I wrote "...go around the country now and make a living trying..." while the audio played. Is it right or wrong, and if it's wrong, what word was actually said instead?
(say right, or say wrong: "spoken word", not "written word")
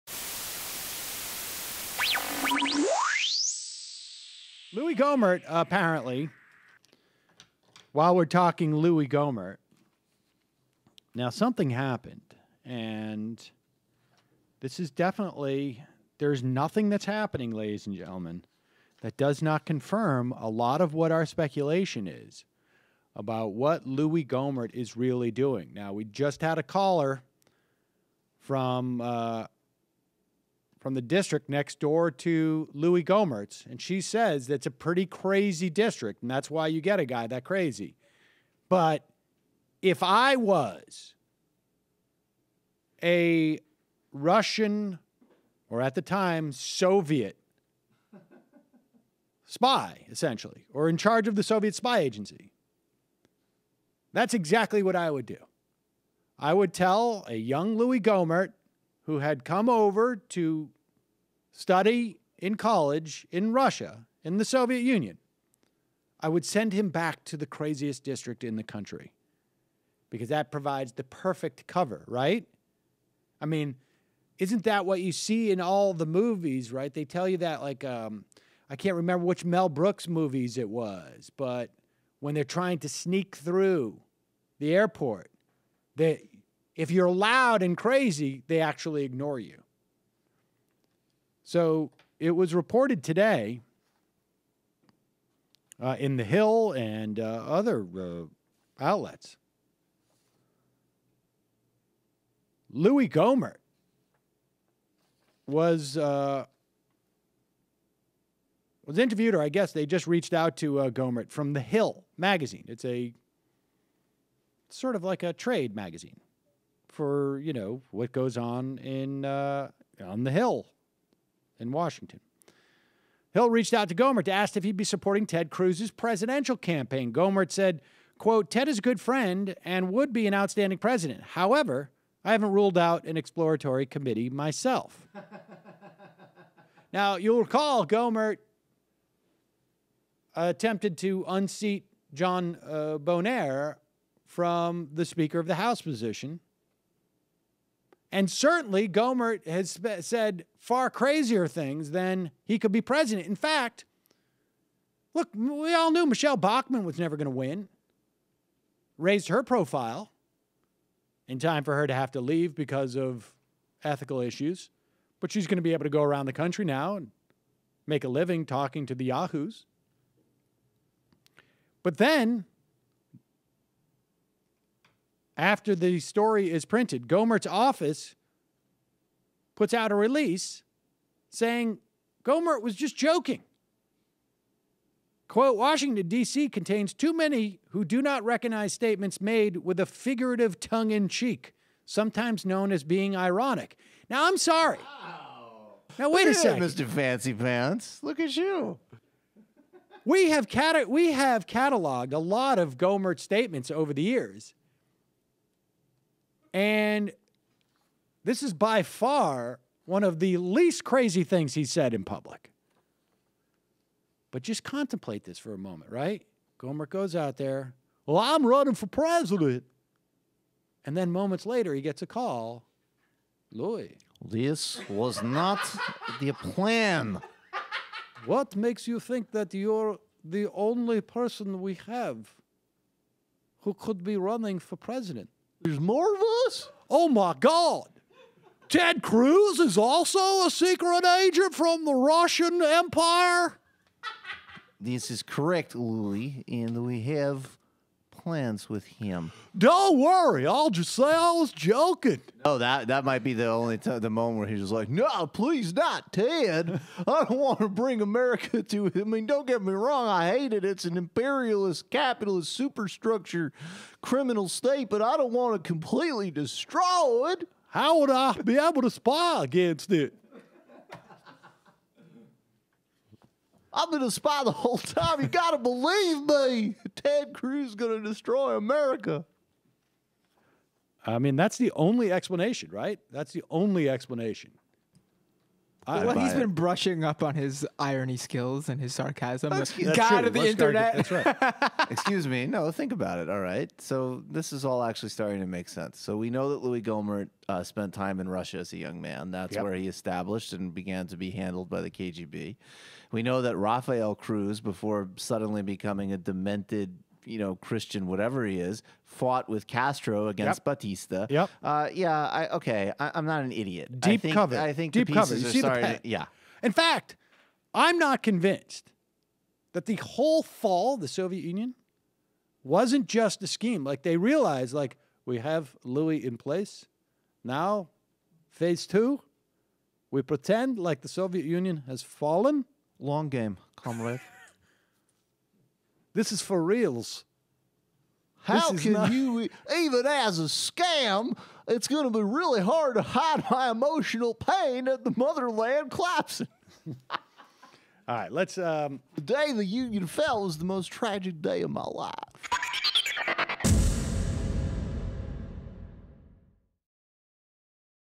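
wrong: "talking", not "trying".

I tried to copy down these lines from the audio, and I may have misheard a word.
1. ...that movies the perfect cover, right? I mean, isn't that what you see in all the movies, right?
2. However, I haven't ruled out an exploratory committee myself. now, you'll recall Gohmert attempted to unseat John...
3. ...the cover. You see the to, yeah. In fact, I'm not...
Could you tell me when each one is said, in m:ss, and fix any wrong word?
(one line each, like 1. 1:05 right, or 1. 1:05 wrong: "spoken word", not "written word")
1. 1:10 wrong: "provides", not "movies"
2. 2:11 right
3. 5:15 right.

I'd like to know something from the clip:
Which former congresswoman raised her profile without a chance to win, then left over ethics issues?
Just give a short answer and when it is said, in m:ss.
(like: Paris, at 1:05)
Michelle Bachmann, at 2:36.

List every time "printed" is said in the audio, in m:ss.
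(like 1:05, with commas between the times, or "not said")
2:56.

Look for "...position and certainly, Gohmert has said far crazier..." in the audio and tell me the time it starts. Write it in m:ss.
2:25.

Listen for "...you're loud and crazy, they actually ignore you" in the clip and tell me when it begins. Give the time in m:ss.
1:26.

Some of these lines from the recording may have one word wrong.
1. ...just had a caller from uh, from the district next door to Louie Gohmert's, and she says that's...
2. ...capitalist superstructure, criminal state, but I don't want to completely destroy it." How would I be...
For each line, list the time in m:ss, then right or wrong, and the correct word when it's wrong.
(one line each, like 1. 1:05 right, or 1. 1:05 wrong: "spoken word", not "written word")
1. 0:26 right
2. 4:21 right.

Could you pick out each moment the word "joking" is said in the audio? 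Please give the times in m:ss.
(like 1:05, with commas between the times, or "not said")
3:02, 4:11.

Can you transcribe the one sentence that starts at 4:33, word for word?
I've been a spy the whole time.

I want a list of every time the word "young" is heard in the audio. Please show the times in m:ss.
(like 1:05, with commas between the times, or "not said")
0:57, 4:58.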